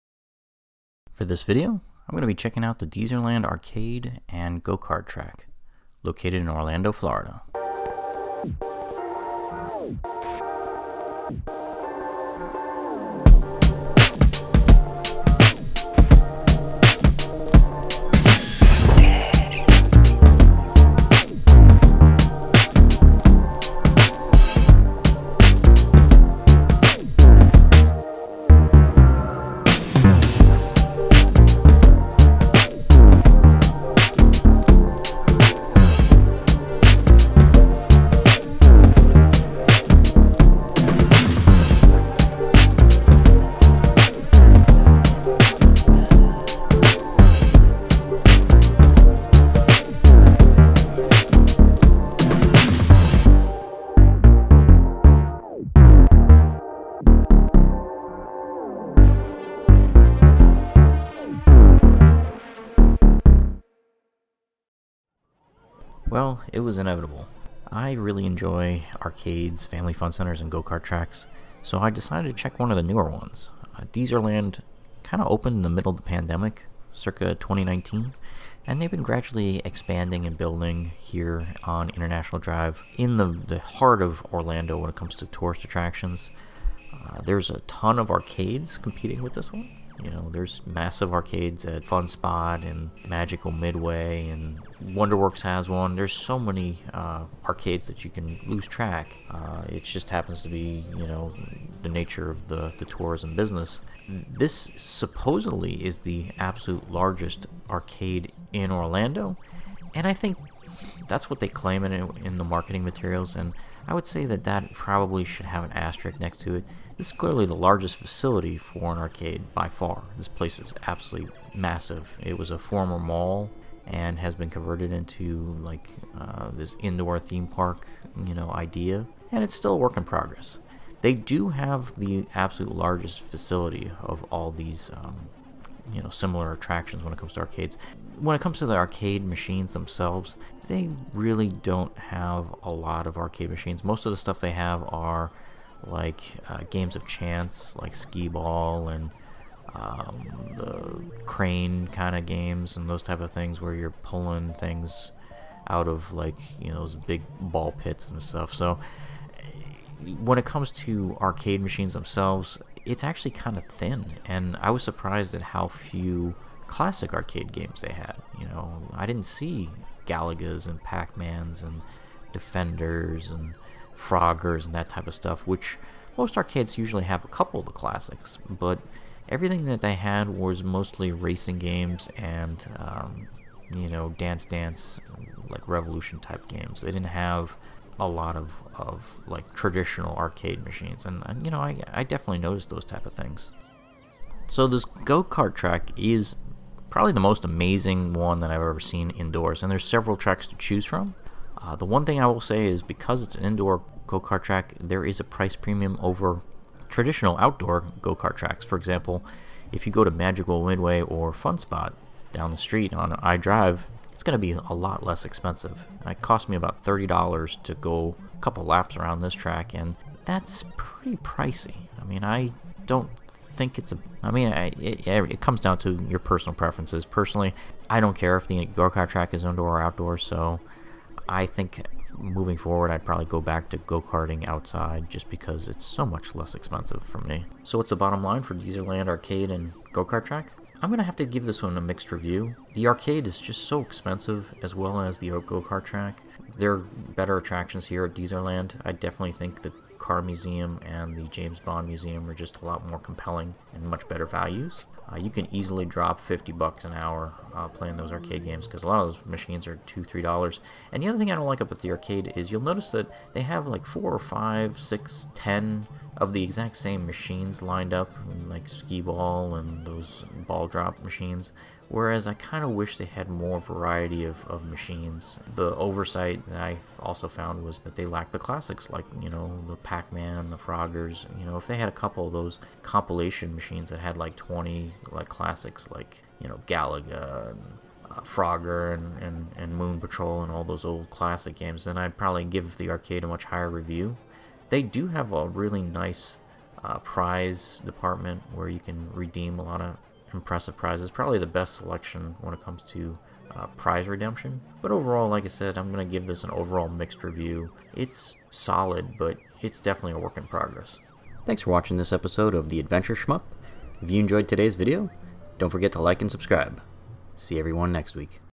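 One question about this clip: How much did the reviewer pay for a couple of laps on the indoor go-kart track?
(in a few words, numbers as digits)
$30.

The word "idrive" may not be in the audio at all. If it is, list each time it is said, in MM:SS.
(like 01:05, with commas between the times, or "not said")
03:33.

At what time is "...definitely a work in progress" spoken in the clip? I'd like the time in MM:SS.
05:09.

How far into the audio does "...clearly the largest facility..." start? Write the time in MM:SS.
01:57.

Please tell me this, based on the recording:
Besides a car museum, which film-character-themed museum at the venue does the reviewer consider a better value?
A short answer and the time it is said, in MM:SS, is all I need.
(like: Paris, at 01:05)
James Bond Museum, at 04:11.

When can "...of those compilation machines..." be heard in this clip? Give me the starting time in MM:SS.
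04:42.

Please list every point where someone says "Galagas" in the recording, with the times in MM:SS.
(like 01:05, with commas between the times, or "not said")
02:50, 04:46.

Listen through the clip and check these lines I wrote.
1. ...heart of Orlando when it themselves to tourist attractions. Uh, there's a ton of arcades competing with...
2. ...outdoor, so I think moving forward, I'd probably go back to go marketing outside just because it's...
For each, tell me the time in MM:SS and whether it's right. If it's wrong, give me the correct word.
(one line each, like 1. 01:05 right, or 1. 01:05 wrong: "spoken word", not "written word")
1. 01:23 wrong: "comes", not "themselves"
2. 03:49 wrong: "karting", not "marketing".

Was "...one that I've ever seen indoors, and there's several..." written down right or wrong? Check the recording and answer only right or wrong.
right.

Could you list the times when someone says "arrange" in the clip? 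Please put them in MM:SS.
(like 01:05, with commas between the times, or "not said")
not said.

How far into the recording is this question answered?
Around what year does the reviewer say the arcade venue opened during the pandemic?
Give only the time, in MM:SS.
01:17.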